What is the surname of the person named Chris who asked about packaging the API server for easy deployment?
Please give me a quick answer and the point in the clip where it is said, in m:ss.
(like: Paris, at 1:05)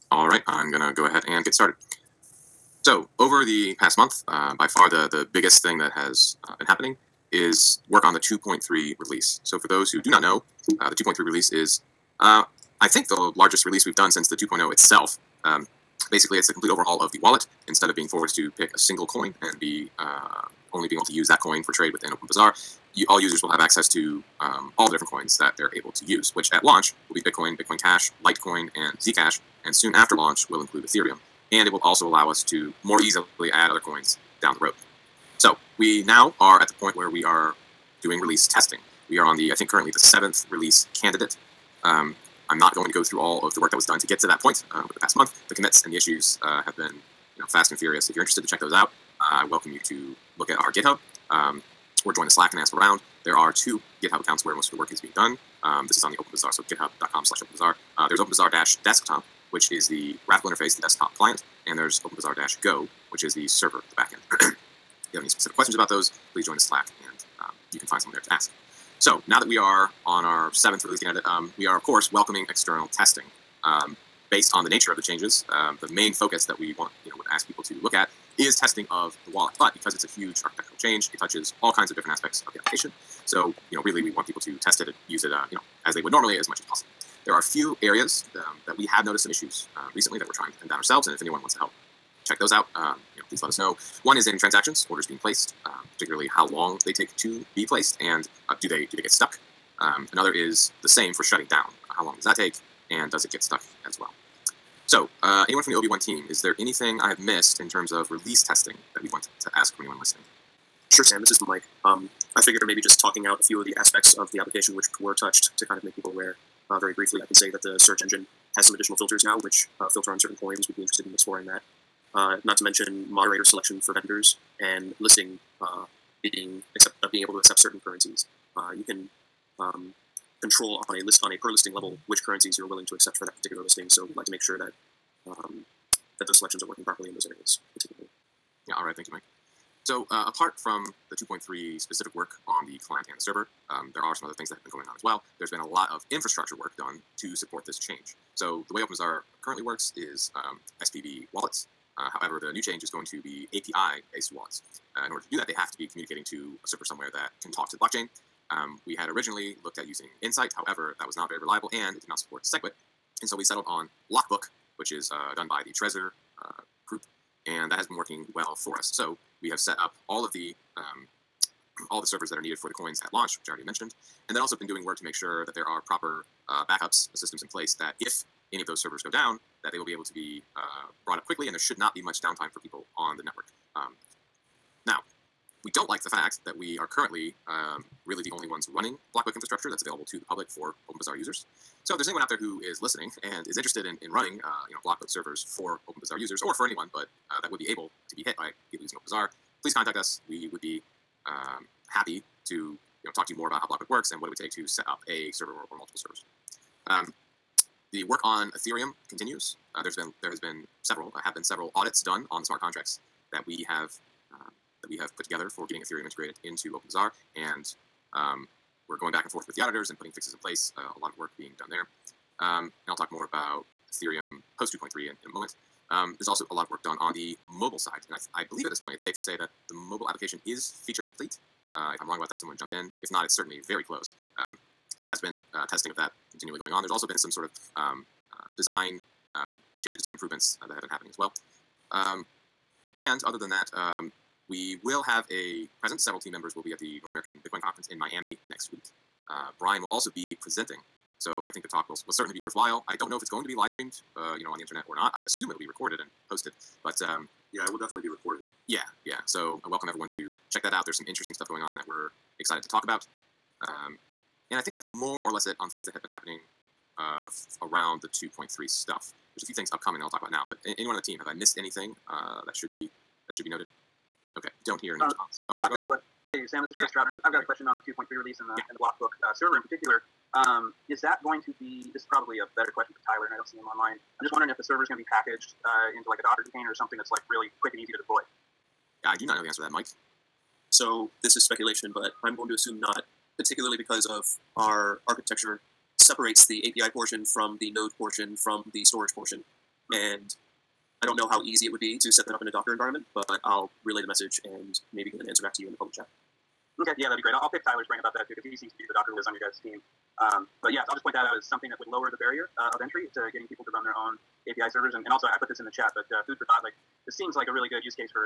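Troutner, at 4:37.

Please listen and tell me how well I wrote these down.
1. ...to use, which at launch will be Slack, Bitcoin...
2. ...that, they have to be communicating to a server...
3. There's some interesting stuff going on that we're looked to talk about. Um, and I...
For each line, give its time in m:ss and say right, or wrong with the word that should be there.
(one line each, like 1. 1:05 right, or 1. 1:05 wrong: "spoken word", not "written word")
1. 0:25 wrong: "Bitcoin", not "Slack"
2. 2:35 right
3. 4:20 wrong: "excited", not "looked".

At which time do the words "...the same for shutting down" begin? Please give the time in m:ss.
1:40.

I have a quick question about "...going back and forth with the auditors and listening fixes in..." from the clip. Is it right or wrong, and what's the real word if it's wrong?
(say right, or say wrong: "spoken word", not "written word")
wrong: "putting", not "listening".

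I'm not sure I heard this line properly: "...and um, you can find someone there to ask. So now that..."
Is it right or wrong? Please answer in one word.
right.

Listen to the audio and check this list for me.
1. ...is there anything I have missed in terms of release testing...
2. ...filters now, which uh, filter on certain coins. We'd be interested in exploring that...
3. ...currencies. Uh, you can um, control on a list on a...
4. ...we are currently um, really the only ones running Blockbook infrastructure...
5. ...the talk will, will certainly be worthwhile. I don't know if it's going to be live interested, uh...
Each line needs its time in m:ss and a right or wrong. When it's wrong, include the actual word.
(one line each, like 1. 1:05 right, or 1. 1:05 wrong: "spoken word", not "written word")
1. 1:46 right
2. 1:58 right
3. 2:07 right
4. 3:06 right
5. 4:11 wrong: "streamed", not "interested".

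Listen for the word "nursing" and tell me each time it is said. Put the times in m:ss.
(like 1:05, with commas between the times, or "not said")
not said.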